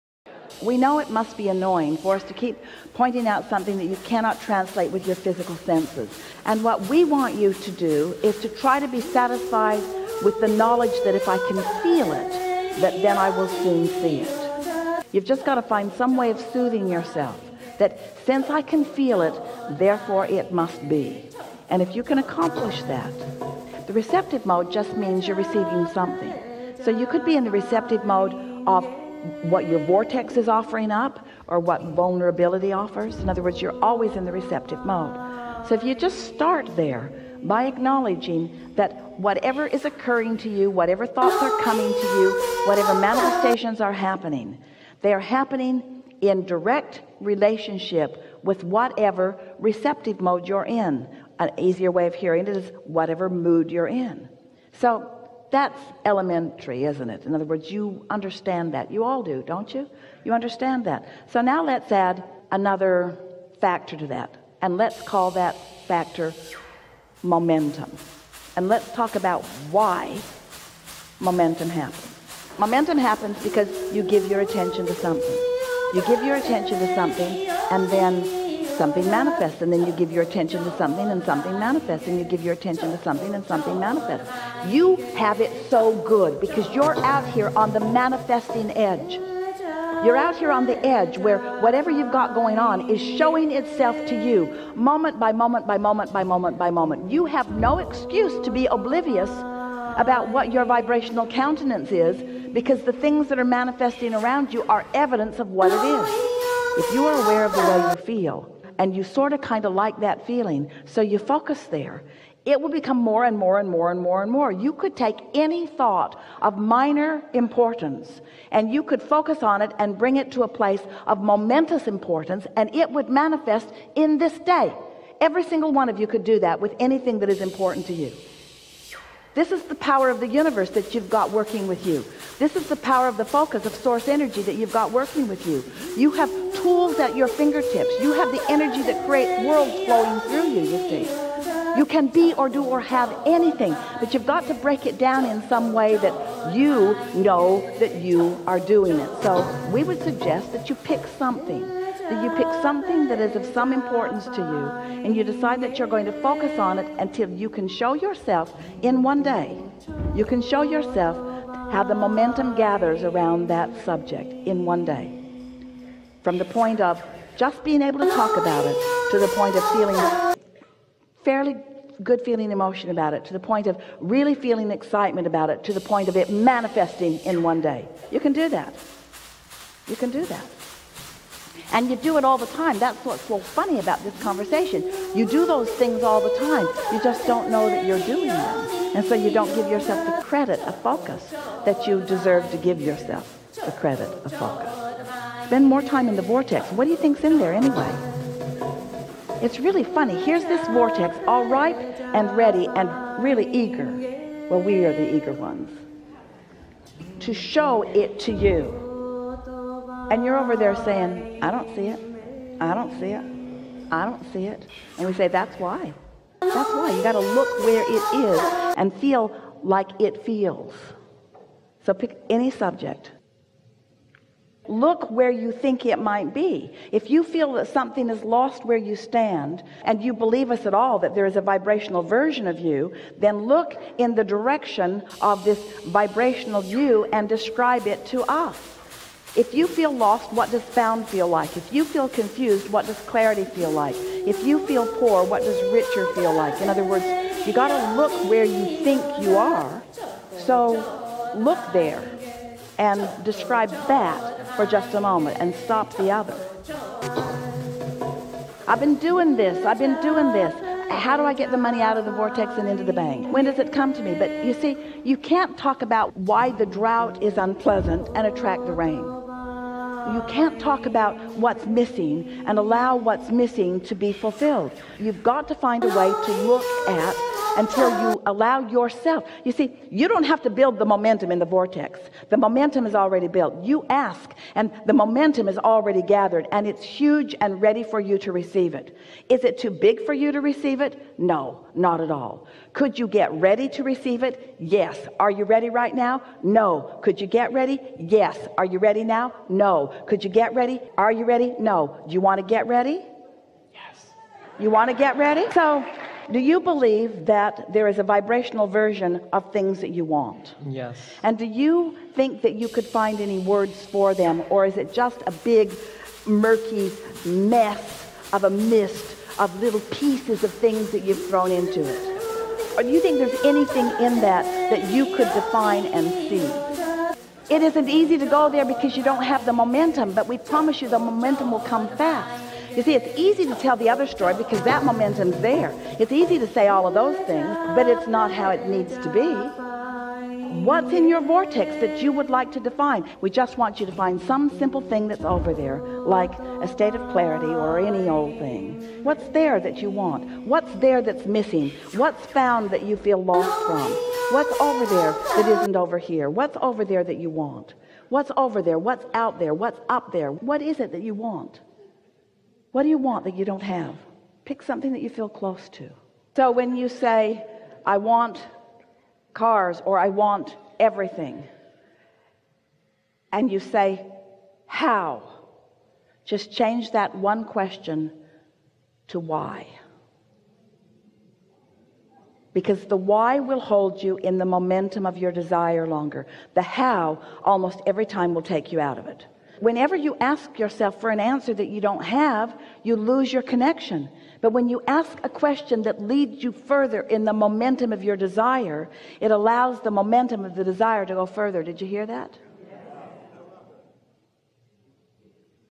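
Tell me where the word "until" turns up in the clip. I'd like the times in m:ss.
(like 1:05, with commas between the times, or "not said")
2:36, 4:37.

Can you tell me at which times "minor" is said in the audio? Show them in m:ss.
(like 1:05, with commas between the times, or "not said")
1:56.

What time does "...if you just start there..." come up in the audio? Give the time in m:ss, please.
0:35.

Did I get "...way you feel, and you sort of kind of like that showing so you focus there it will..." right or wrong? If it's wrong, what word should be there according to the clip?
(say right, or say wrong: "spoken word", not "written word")
wrong: "feeling", not "showing".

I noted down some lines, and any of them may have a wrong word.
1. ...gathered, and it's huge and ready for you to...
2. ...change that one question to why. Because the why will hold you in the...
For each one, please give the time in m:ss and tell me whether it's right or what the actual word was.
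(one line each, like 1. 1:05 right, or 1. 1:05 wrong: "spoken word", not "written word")
1. 4:46 right
2. 6:16 right.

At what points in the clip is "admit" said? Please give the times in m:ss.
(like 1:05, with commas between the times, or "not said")
not said.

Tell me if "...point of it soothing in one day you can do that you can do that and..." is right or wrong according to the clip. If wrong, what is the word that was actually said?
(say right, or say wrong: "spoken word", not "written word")
wrong: "manifesting", not "soothing".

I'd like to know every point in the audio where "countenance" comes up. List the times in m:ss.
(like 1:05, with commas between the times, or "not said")
1:41.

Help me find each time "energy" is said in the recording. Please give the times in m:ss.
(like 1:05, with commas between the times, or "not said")
2:14, 2:18.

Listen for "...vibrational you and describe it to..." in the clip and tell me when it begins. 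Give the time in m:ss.
3:55.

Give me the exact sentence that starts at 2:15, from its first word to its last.
You have tools at your fingertips.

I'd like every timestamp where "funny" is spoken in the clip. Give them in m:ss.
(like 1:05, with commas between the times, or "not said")
3:03, 3:19.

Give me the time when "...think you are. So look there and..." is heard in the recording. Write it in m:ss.
4:08.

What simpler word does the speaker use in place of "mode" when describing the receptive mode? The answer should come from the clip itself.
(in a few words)
mood.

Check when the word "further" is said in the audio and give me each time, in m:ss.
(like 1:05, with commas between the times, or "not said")
6:36, 6:41.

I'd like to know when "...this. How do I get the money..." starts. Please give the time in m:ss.
4:20.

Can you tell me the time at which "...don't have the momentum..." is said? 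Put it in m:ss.
5:29.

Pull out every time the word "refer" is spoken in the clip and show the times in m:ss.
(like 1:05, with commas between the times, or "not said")
not said.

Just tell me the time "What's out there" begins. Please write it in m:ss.
5:58.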